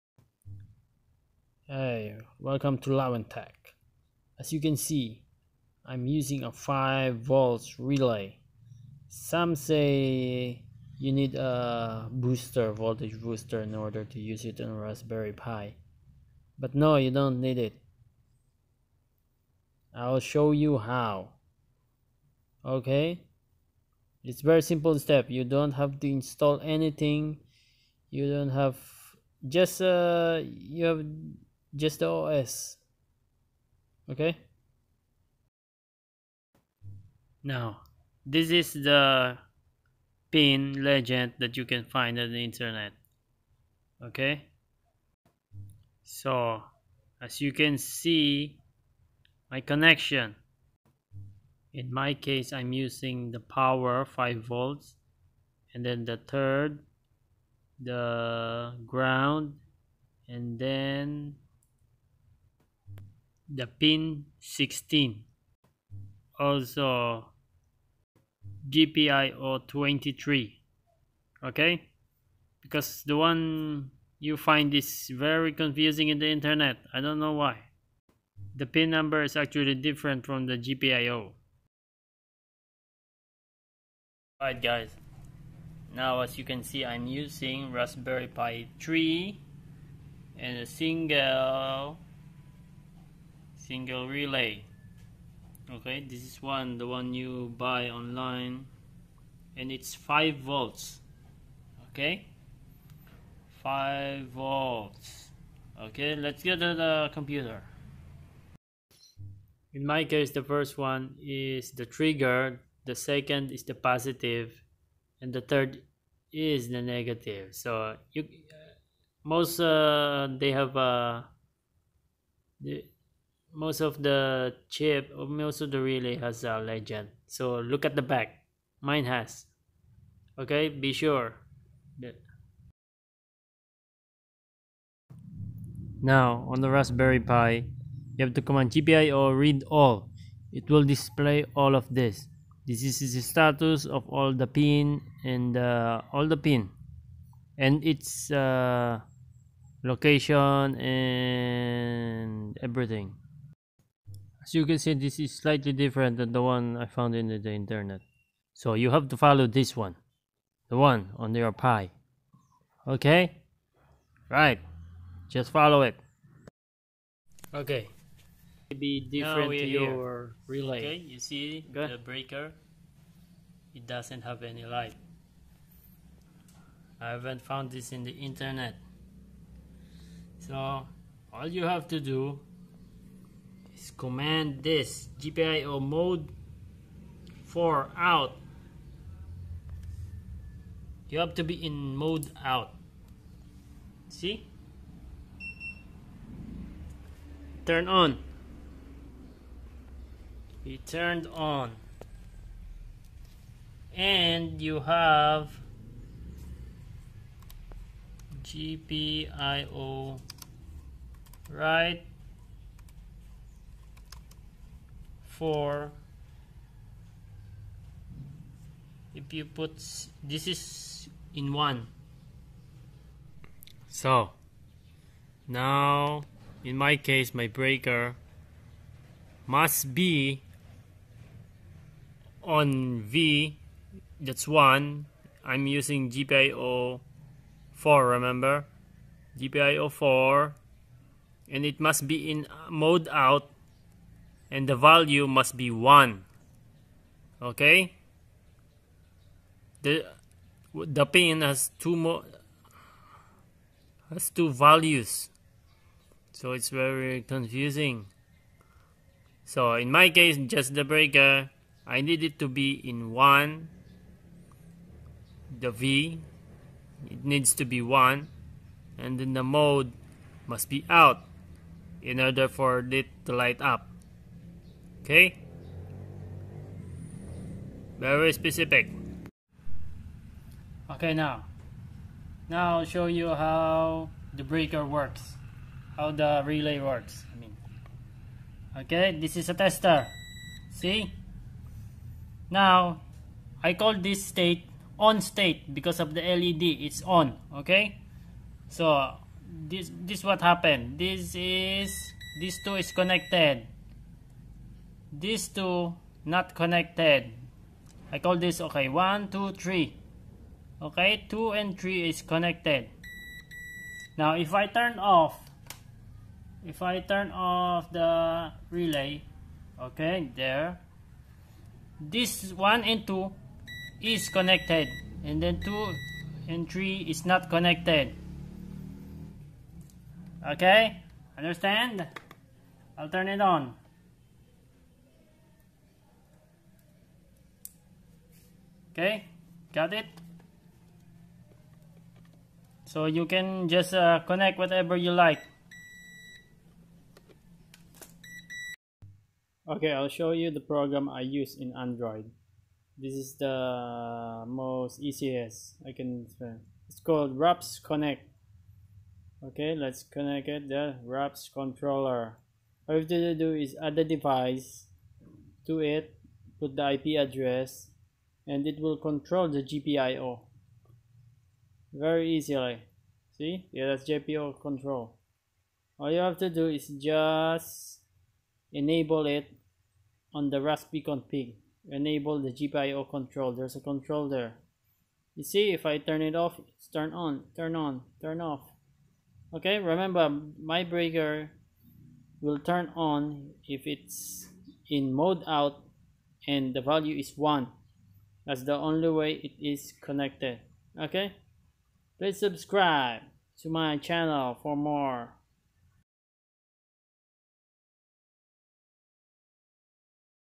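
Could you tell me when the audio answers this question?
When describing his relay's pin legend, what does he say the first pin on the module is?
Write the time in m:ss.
1:51.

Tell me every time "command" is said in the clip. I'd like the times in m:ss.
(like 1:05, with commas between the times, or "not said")
2:18, 3:03.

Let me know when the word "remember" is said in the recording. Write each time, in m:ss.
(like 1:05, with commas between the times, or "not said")
3:58, 6:29.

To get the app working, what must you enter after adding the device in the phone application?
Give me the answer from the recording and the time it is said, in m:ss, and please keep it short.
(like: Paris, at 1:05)
the IP address, at 6:06.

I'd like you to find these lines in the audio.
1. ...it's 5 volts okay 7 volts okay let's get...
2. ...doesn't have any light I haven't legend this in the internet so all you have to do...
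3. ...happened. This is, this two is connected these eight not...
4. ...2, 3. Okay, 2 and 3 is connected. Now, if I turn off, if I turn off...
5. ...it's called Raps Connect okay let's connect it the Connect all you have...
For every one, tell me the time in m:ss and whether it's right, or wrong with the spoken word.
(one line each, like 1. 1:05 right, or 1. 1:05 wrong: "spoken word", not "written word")
1. 1:39 wrong: "5", not "7"
2. 2:53 wrong: "found", not "legend"
3. 5:00 wrong: "two", not "eight"
4. 5:09 right
5. 5:56 wrong: "RaspController", not "Connect".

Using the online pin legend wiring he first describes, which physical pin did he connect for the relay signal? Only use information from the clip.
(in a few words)
16.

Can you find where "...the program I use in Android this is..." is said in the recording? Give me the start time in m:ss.
5:50.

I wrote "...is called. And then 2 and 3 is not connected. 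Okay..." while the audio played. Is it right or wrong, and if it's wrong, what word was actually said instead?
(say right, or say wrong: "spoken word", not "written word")
wrong: "connected", not "called".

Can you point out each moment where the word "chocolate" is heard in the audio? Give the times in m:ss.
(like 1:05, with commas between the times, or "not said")
not said.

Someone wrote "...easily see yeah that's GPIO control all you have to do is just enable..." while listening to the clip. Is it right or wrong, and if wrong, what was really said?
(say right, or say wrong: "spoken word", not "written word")
right.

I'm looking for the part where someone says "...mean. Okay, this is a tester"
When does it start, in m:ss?
4:47.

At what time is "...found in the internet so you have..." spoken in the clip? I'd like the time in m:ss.
2:36.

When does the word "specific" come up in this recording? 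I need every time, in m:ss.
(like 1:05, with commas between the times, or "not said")
4:38.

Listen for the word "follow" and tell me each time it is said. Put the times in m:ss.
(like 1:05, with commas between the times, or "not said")
2:39, 2:45.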